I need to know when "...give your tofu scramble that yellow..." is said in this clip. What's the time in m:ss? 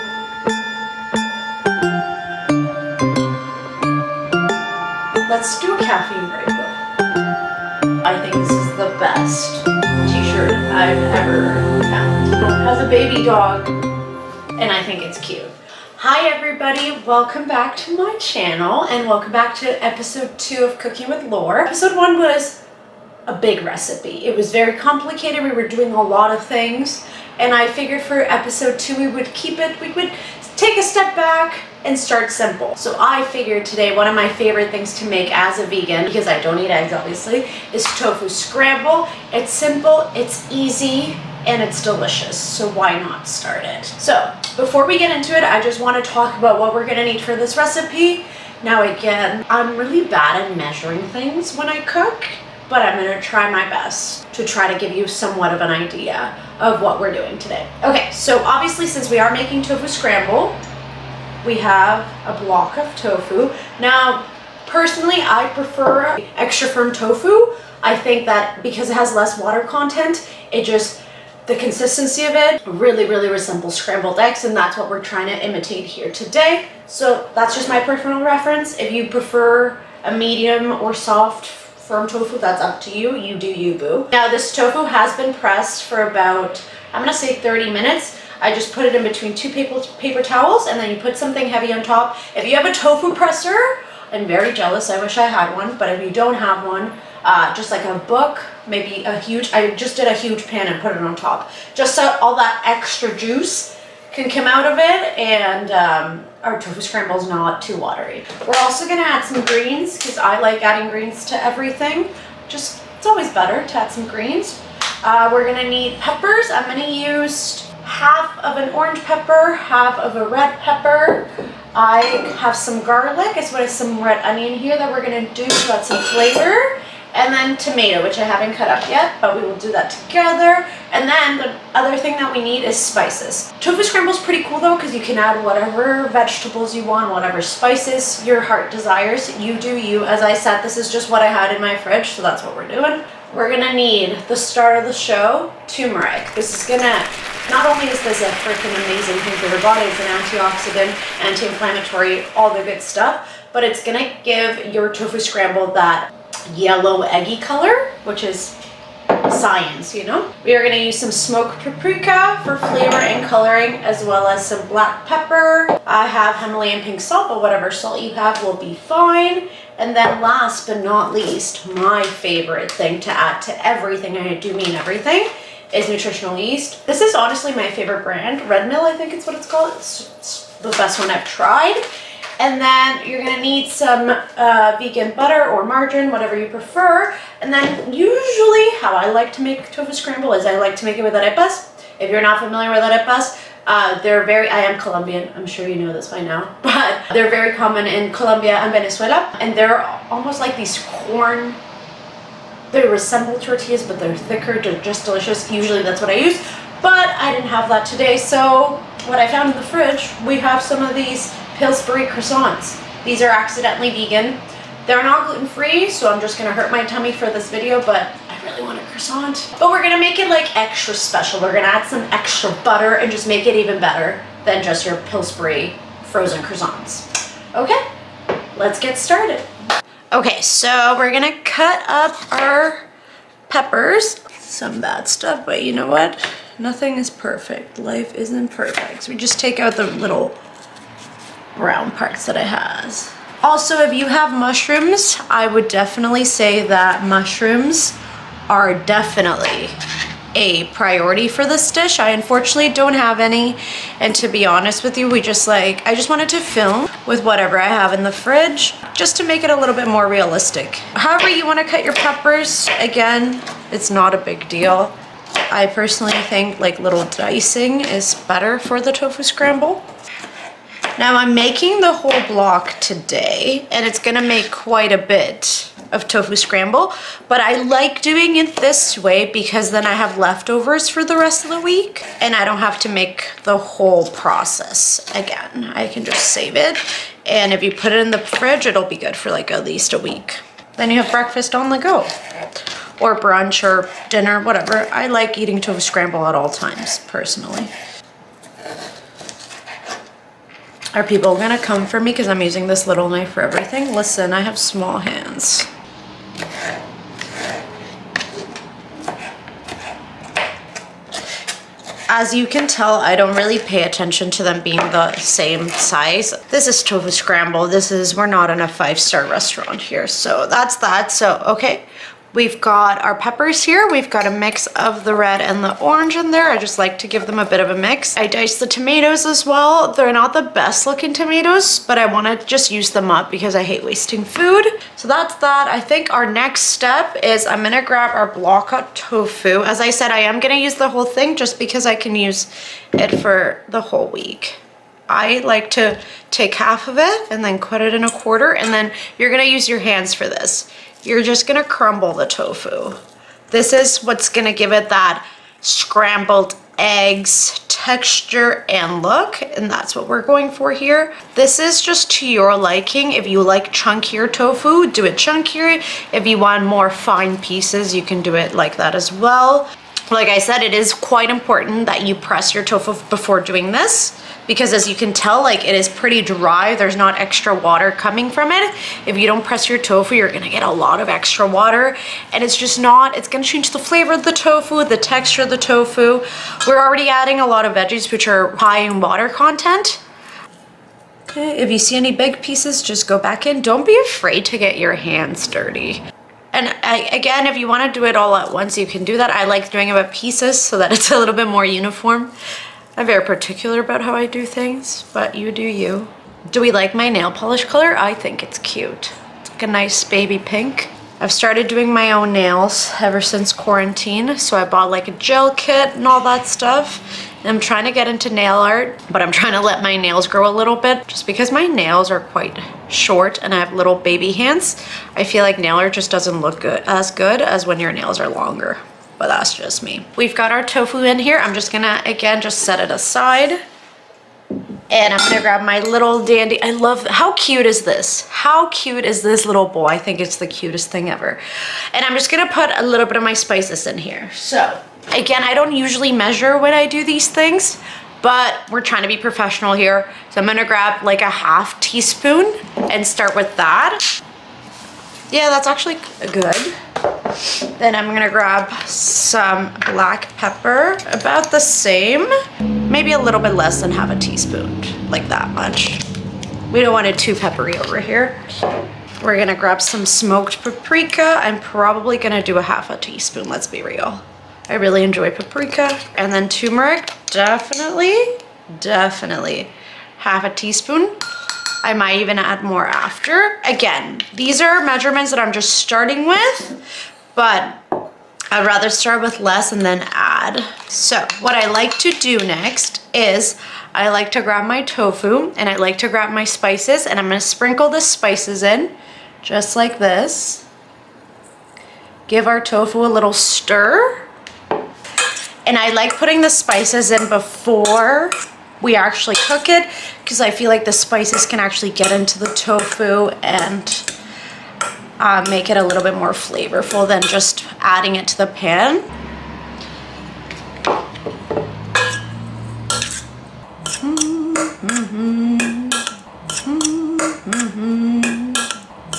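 2:34.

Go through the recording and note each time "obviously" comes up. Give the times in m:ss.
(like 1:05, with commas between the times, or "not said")
0:36, 0:58.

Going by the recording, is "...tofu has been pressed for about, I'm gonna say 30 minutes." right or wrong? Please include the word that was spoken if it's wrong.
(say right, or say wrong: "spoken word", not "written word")
right.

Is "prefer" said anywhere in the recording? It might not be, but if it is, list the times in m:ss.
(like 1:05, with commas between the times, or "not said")
1:05, 1:19, 3:06.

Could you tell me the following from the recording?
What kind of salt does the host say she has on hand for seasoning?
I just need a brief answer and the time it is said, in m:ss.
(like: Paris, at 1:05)
Himalayan pink salt, at 2:46.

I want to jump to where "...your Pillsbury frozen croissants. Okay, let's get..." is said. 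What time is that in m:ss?
3:44.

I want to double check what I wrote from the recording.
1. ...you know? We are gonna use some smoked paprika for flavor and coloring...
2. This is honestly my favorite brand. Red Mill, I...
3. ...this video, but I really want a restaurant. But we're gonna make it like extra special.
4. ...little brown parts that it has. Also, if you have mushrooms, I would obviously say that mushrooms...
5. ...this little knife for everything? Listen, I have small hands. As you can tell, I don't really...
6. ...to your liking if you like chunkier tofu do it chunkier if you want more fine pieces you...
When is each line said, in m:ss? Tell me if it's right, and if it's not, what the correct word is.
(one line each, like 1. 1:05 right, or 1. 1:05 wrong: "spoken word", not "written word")
1. 2:39 right
2. 2:56 right
3. 3:37 wrong: "croissant", not "restaurant"
4. 3:59 wrong: "definitely", not "obviously"
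5. 5:02 right
6. 6:02 right.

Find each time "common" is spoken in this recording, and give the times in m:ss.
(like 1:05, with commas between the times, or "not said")
3:17.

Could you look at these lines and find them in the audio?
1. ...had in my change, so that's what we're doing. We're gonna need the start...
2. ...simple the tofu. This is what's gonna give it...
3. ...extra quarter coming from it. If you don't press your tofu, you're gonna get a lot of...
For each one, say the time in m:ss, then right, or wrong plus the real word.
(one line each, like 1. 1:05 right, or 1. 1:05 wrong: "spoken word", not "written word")
1. 2:21 wrong: "fridge", not "change"
2. 5:51 wrong: "crumble", not "simple"
3. 6:17 wrong: "water", not "quarter".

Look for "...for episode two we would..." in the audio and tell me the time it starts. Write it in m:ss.
0:28.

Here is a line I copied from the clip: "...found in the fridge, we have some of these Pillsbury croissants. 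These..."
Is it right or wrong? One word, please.
right.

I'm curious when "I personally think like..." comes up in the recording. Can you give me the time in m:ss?
4:25.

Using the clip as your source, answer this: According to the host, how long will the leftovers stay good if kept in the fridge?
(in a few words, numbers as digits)
At least a week.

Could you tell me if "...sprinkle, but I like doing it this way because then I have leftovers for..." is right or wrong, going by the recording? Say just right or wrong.
wrong.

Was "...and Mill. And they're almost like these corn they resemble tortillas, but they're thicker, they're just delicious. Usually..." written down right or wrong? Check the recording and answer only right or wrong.
wrong.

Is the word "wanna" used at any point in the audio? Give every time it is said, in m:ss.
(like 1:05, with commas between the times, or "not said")
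4:21, 5:32.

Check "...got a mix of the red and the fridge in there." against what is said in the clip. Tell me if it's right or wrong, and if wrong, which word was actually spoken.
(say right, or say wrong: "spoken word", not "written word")
wrong: "orange", not "fridge".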